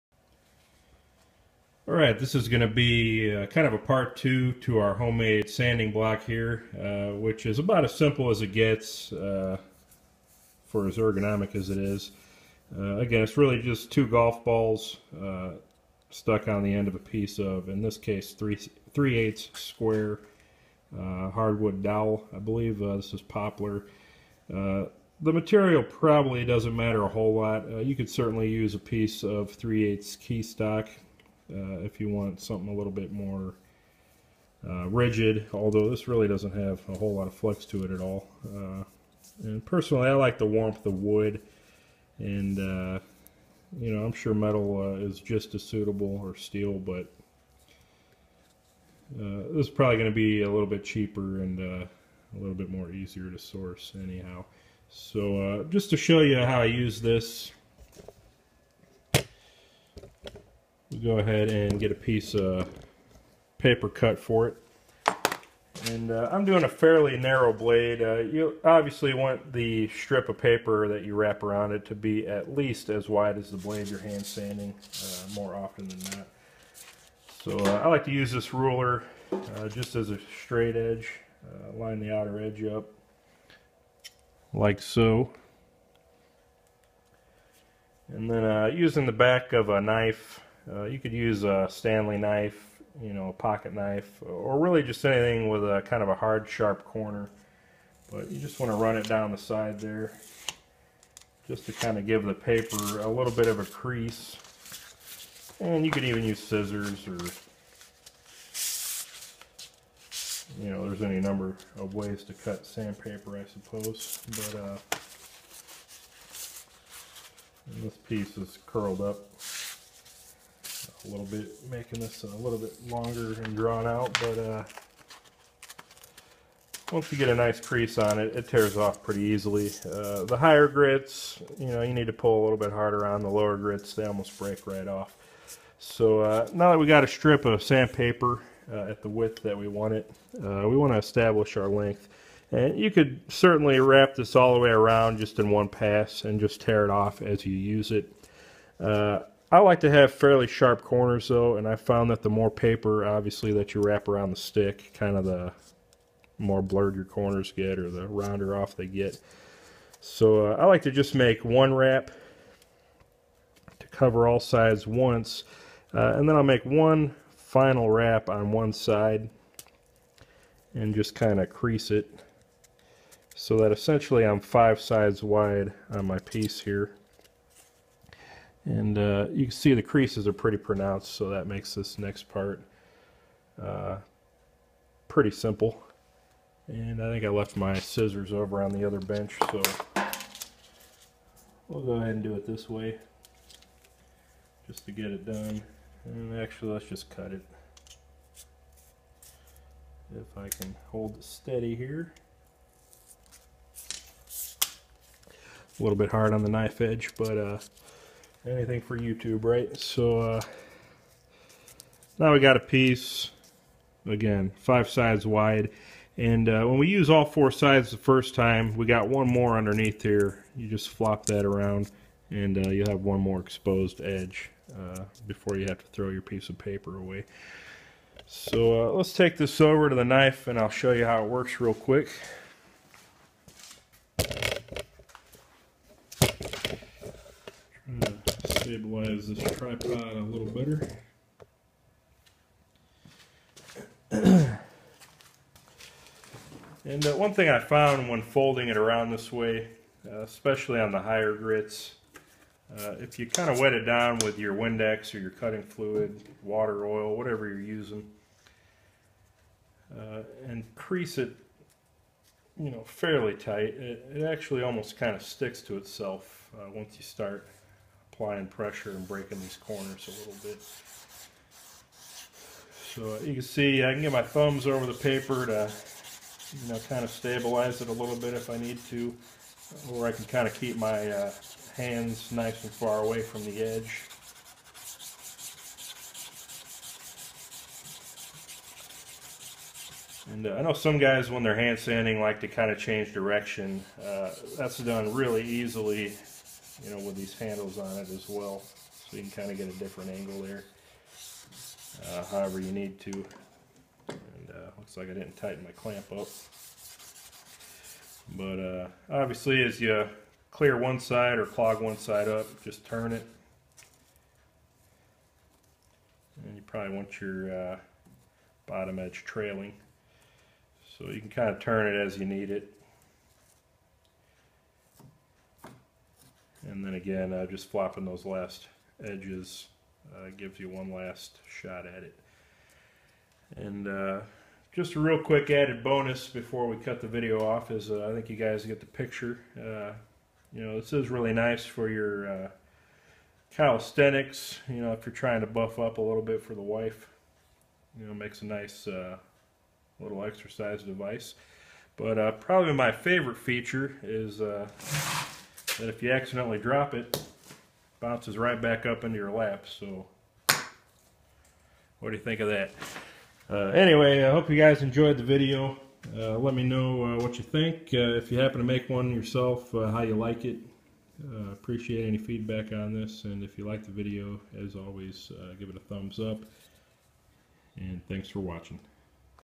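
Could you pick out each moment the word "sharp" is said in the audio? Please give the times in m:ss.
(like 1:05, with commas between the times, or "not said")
1:36, 2:30.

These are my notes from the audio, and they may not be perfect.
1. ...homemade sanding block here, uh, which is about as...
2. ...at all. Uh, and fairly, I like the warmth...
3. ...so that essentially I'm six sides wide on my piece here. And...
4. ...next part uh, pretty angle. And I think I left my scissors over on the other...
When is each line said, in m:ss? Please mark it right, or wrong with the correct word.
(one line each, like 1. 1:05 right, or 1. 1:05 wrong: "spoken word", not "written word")
1. 0:04 right
2. 0:37 wrong: "personally", not "fairly"
3. 2:53 wrong: "five", not "six"
4. 3:01 wrong: "simple", not "angle".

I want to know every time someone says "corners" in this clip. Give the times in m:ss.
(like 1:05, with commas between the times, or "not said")
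1:36, 2:30, 2:37, 4:29.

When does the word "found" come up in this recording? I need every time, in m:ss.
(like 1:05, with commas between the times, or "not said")
2:31, 4:07.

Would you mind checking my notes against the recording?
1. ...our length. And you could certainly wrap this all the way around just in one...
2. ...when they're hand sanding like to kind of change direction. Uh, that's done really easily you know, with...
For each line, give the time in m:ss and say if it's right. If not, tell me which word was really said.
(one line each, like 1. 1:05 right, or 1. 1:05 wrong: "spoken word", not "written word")
1. 2:21 right
2. 4:51 right.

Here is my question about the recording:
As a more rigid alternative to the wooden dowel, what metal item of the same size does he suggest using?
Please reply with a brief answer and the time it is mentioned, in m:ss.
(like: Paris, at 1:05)
Key stock, at 0:30.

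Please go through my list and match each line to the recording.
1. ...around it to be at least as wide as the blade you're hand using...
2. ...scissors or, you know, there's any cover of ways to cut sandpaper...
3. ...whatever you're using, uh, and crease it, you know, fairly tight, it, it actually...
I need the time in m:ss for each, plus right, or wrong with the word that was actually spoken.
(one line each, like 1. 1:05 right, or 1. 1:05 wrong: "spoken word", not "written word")
1. 1:11 wrong: "sanding", not "using"
2. 1:46 wrong: "number", not "cover"
3. 4:17 right.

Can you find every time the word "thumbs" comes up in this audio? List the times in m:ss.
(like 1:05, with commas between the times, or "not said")
4:34, 6:15.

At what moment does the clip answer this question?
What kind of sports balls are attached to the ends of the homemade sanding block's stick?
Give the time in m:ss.
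0:14.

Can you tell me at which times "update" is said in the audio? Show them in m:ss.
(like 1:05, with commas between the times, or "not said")
not said.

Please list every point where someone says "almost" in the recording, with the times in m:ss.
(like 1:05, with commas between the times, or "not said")
2:14, 4:24.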